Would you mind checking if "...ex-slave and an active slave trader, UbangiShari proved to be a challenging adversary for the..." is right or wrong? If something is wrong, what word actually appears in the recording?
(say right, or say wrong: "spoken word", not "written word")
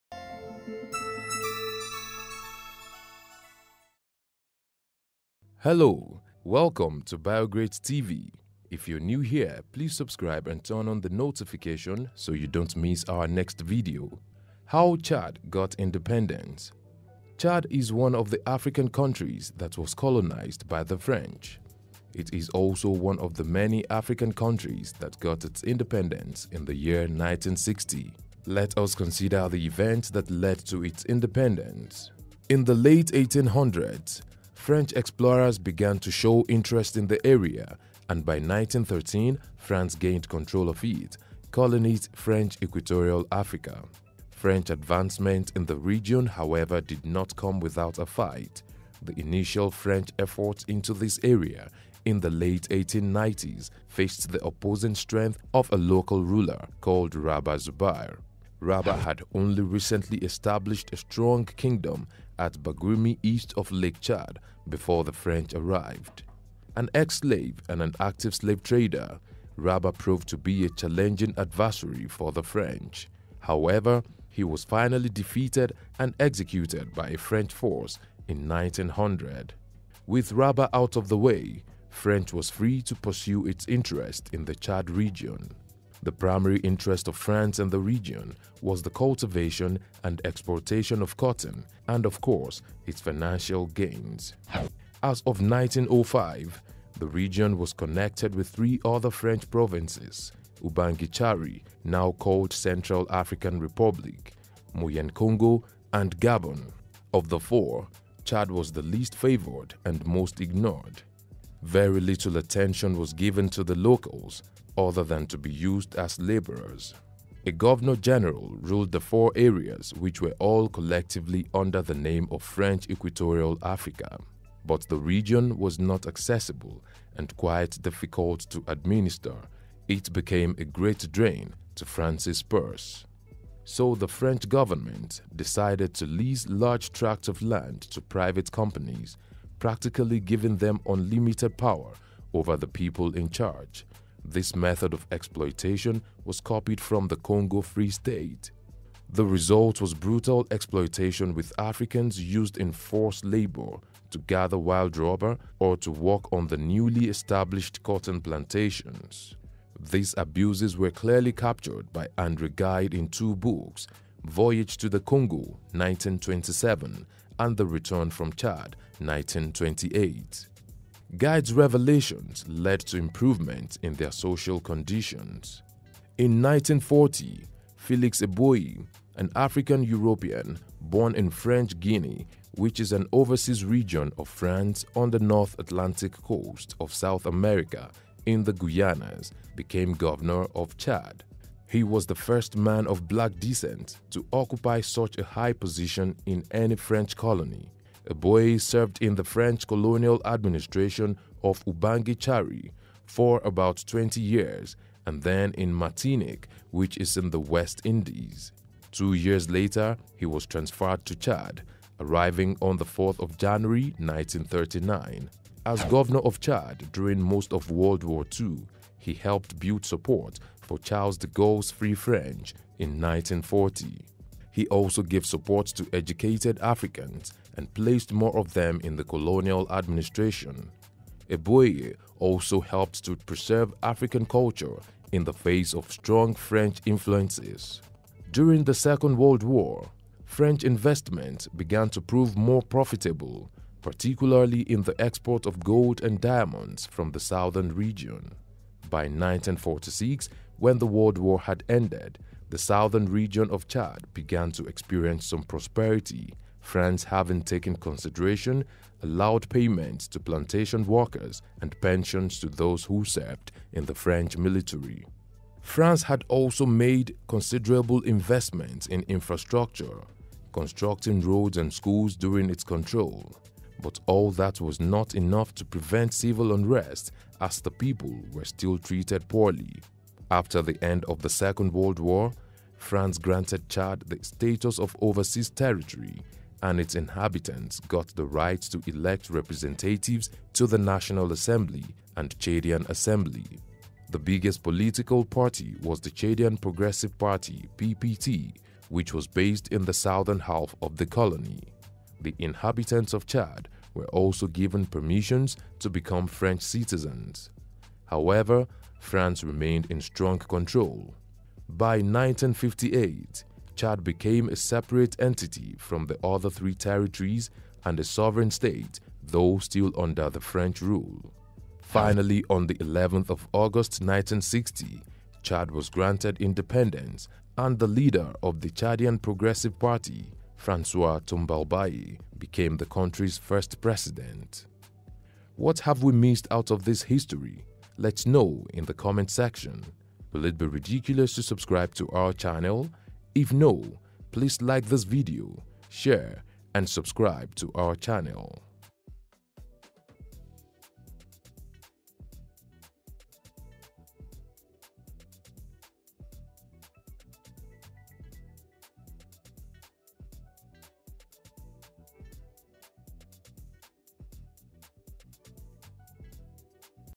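wrong: "Rabah", not "UbangiShari".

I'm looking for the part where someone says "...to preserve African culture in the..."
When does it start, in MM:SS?
03:53.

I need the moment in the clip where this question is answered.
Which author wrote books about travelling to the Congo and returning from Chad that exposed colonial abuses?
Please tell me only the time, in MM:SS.
02:42.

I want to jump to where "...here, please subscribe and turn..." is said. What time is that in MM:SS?
00:09.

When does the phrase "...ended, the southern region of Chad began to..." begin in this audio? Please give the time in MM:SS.
04:11.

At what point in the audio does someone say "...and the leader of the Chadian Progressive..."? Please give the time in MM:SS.
05:27.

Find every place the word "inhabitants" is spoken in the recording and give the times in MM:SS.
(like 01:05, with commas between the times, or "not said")
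04:46, 05:02.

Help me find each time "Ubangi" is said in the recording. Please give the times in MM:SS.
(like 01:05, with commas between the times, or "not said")
01:40, 03:21.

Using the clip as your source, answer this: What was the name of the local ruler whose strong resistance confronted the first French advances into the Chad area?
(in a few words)
Rabah Zubayr.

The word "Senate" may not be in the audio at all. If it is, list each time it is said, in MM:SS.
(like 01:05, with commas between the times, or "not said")
not said.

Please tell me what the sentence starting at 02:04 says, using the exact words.
But the region was not accessible and quite difficult to administer.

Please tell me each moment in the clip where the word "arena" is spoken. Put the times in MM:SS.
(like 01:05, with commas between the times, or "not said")
not said.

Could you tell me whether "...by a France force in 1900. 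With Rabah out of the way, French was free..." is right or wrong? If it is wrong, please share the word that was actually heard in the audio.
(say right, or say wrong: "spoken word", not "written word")
wrong: "French", not "France".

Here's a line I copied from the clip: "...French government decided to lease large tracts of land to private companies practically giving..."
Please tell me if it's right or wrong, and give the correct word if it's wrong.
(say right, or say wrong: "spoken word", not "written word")
right.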